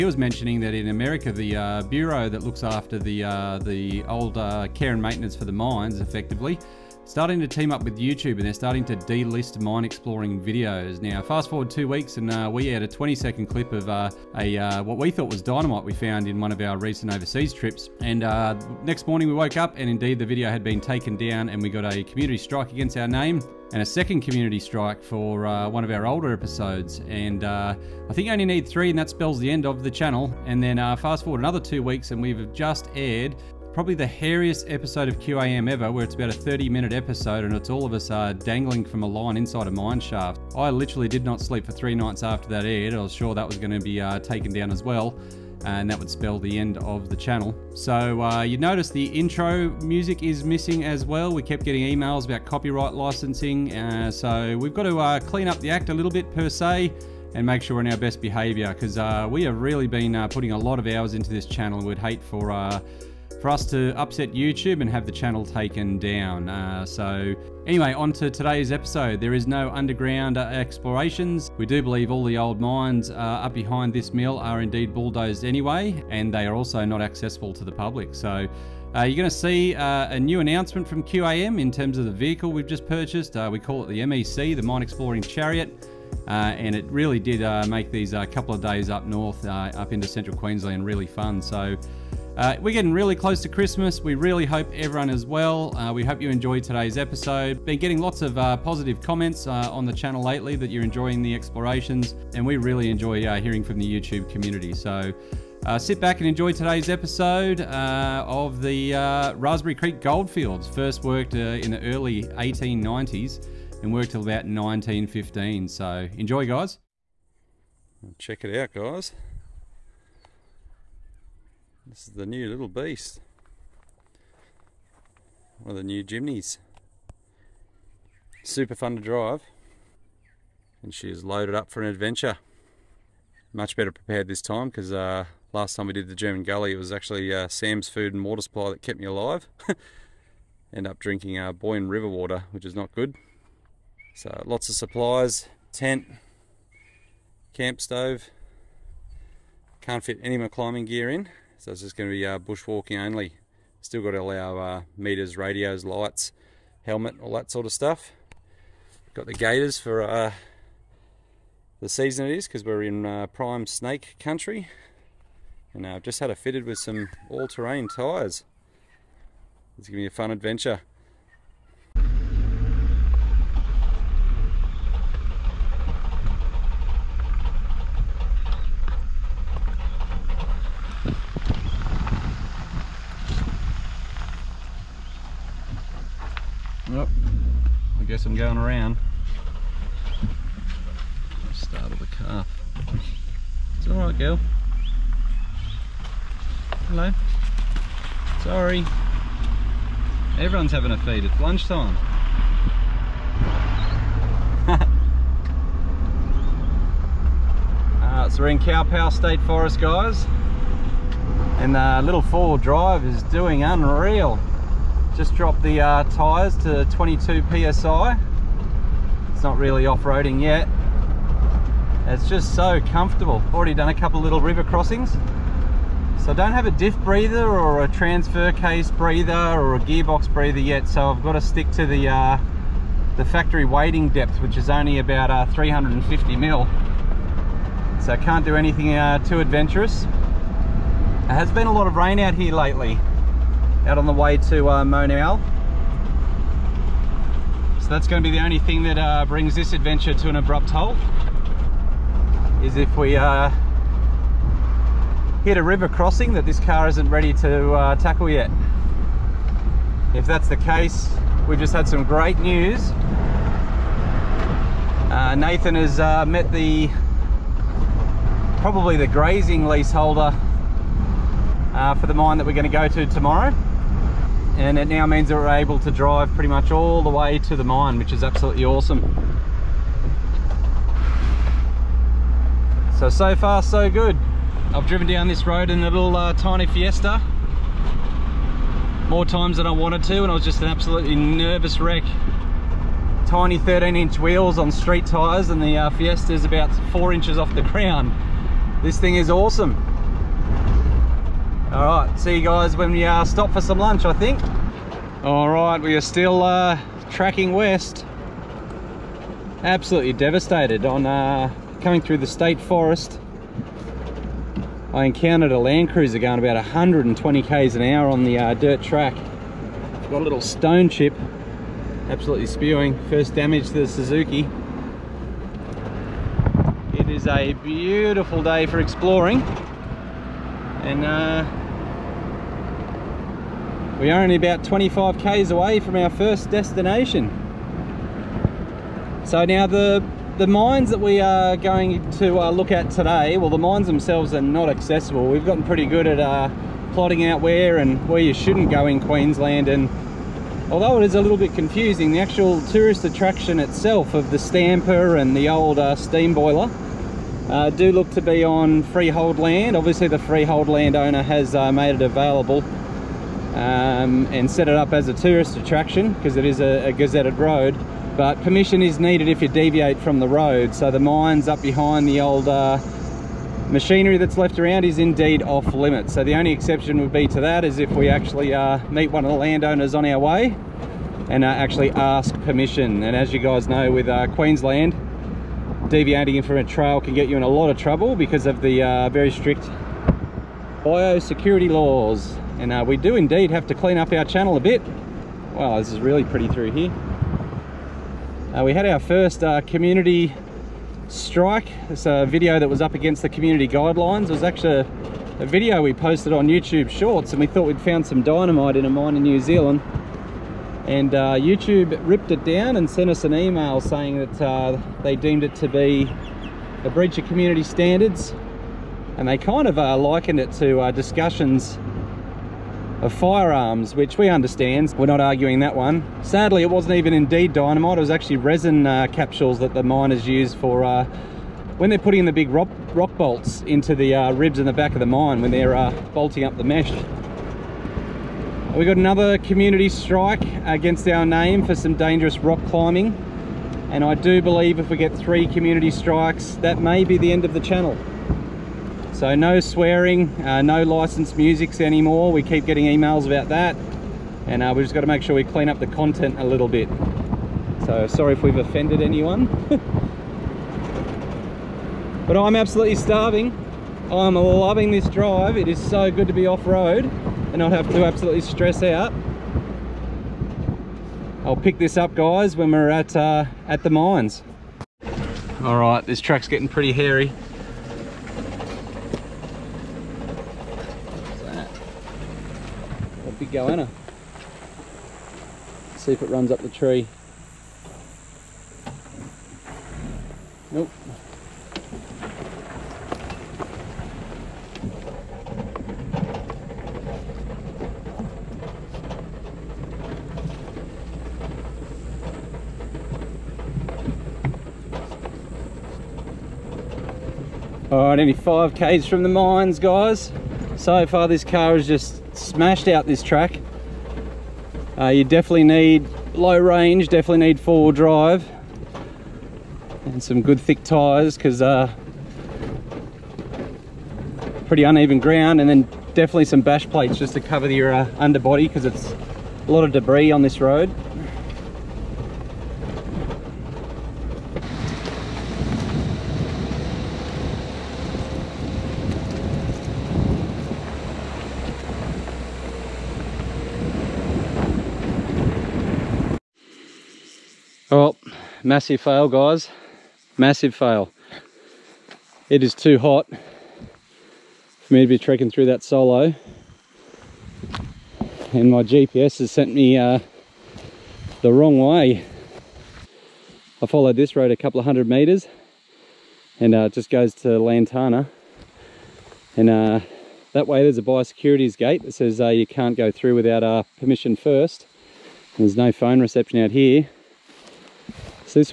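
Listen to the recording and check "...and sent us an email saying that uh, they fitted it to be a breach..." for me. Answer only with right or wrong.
wrong.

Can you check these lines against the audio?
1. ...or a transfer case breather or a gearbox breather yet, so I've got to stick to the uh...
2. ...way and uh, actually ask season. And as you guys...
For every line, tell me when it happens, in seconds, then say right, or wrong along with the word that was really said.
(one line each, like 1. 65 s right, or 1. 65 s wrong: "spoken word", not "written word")
1. 227 s right
2. 380 s wrong: "permission", not "season".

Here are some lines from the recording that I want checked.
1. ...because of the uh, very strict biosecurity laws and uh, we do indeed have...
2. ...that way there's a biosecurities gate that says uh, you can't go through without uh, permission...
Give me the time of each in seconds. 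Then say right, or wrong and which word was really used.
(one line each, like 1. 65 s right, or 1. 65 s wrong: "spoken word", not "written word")
1. 388 s right
2. 570 s right.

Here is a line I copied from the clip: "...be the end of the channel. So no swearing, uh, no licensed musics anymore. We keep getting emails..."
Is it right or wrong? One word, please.
right.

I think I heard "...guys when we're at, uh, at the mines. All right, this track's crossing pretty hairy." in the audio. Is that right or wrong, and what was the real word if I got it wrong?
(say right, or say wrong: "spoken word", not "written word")
wrong: "getting", not "crossing".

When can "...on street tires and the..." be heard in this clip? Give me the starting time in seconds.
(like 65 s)
294 s.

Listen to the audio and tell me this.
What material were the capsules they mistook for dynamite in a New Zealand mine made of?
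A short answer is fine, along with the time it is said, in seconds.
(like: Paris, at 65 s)
Resin, at 428 s.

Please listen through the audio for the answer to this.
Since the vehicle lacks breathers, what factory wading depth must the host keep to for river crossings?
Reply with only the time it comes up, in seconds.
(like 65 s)
235 s.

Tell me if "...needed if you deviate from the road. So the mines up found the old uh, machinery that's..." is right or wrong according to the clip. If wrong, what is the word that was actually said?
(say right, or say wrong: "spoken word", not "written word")
wrong: "behind", not "found".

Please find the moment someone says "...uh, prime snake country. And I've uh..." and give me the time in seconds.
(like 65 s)
163 s.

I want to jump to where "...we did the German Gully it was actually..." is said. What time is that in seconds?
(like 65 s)
135 s.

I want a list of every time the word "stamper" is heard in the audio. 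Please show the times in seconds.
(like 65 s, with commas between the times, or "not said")
354 s.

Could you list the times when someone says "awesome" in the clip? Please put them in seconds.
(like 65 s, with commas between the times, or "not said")
278 s, 299 s.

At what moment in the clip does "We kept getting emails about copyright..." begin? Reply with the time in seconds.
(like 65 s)
51 s.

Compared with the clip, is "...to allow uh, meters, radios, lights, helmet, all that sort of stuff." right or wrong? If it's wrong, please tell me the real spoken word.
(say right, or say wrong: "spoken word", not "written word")
right.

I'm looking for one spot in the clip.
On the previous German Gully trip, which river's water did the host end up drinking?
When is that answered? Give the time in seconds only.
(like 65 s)
141 s.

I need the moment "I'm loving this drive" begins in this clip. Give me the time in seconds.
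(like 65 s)
464 s.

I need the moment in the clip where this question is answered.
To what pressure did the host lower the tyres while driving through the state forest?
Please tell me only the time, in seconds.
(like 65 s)
216 s.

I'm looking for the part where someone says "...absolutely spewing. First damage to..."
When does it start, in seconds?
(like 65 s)
322 s.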